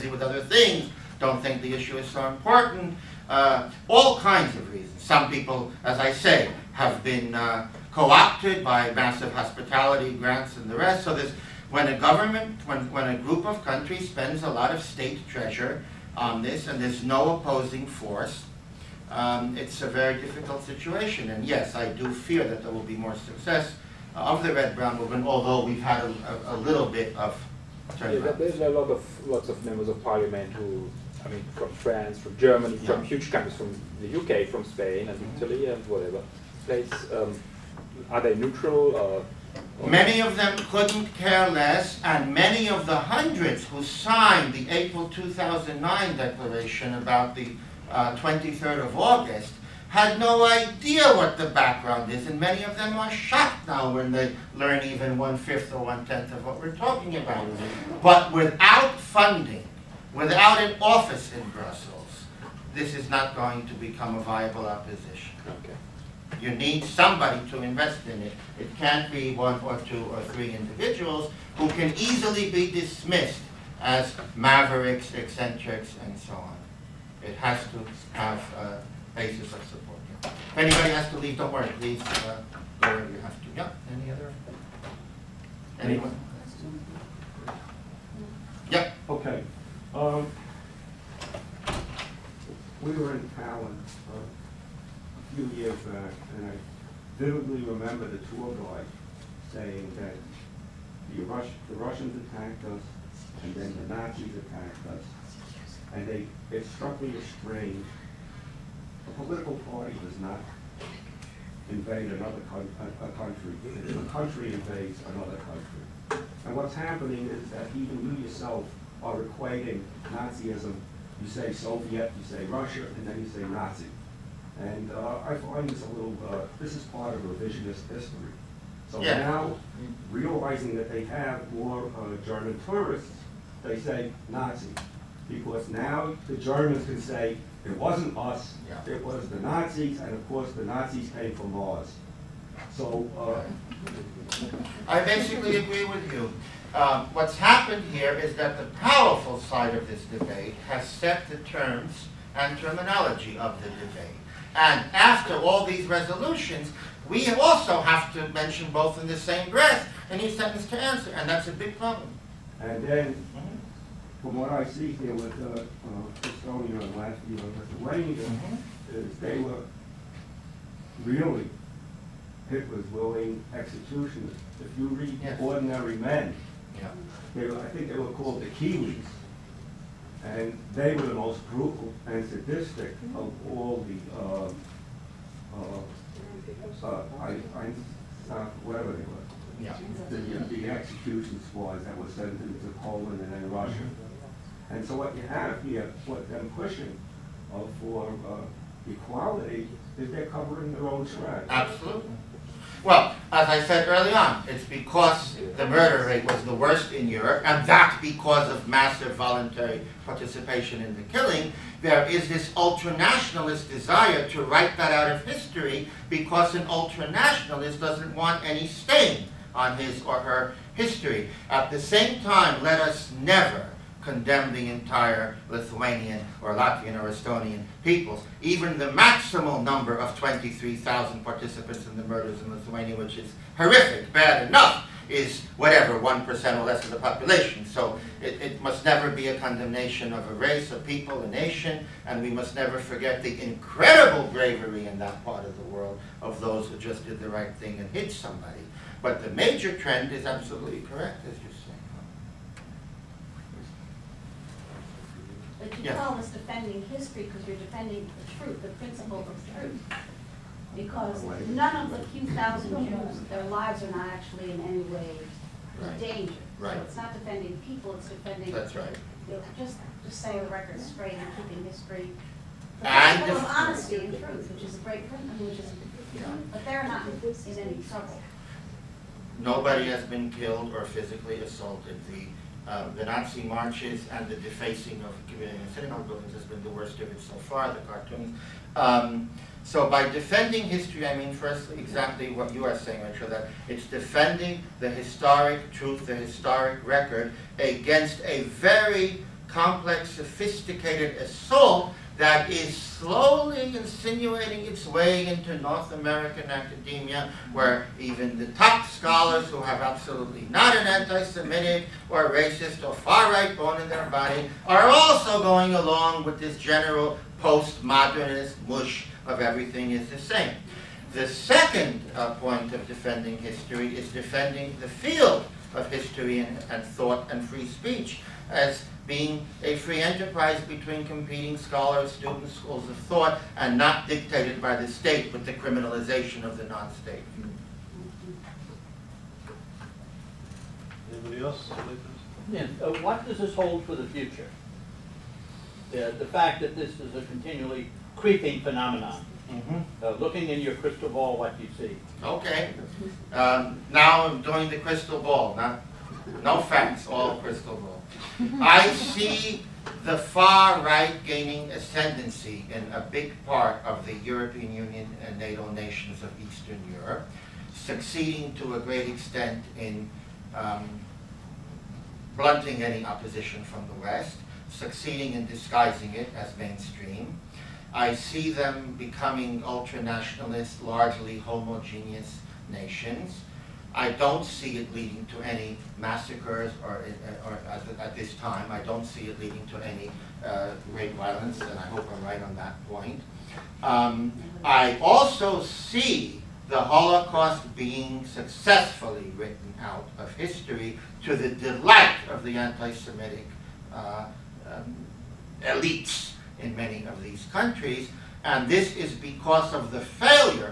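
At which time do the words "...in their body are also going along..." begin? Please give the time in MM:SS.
05:13.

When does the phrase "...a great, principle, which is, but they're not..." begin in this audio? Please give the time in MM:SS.
04:34.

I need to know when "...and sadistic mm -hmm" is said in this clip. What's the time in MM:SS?
03:02.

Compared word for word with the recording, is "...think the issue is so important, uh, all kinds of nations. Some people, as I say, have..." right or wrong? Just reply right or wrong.
wrong.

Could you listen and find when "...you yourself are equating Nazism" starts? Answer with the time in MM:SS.
01:58.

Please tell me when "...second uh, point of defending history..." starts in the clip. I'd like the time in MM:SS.
05:21.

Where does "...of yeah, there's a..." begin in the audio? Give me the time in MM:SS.
00:27.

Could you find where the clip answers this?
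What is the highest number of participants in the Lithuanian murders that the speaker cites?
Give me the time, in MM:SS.
03:50.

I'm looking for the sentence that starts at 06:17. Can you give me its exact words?
I see them becoming ultra-nationalist, largely homogeneous nations, I don't see it leading to any massacres or, or at, at, this time.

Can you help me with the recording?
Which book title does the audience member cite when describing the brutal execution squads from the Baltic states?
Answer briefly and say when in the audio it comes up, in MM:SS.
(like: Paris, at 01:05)
Ordinary Men, at 02:55.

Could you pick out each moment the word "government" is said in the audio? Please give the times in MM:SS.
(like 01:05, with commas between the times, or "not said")
00:11.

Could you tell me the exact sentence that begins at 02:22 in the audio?
So uh, I basically agree with you.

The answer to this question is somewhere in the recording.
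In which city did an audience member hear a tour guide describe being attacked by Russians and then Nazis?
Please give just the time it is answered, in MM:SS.
01:33.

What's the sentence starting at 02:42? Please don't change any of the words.
And then mm-hmm from what I see here with uh, uh, Estonia and Latvia and Lithuania, mm -hmm.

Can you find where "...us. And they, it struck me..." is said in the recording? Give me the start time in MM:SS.
01:44.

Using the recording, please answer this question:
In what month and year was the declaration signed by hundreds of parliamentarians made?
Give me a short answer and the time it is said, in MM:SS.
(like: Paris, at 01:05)
April 2009, at 00:44.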